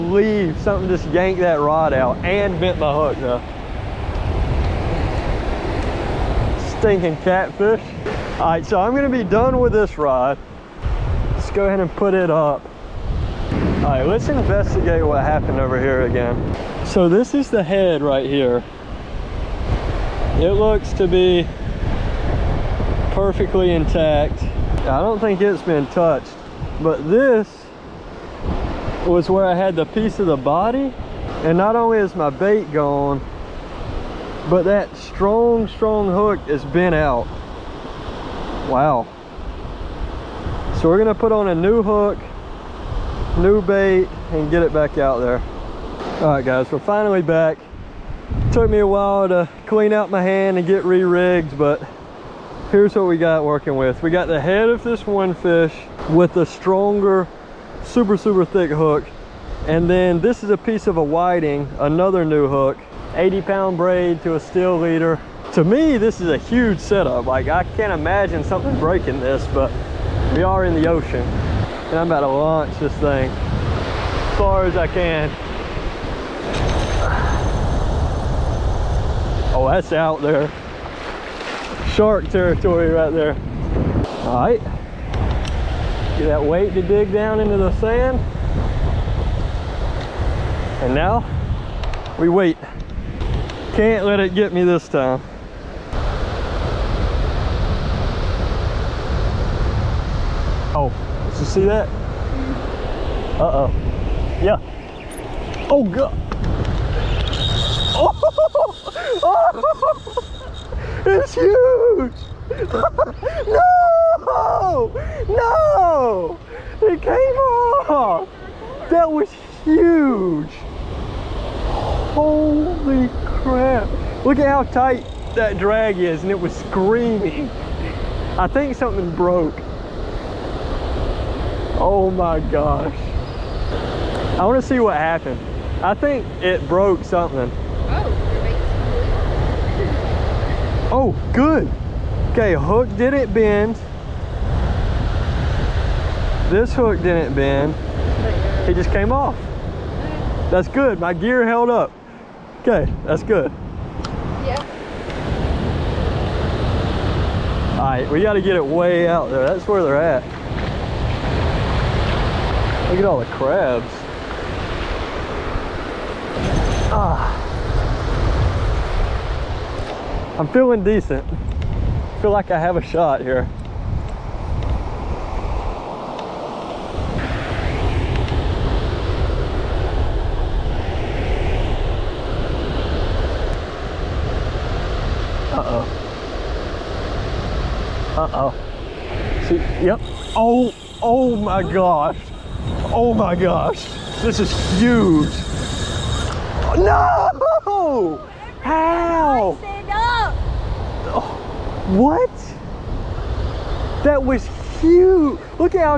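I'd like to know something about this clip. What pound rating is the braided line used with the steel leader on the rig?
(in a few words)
80.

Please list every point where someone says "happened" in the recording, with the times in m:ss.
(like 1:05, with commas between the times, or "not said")
0:15, 2:14.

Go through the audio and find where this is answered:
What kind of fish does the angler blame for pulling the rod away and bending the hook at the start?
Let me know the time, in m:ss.
0:07.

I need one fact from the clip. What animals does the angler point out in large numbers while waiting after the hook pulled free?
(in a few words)
Crabs.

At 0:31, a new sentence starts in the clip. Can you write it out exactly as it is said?
And not only is my bait gone, but that strong, strong hook is bent out.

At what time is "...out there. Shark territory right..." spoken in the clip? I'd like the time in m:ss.
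1:19.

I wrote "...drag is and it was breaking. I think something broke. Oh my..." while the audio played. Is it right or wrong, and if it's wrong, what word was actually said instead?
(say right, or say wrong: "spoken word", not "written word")
wrong: "screaming", not "breaking".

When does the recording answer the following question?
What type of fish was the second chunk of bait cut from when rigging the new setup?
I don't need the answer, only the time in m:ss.
1:01.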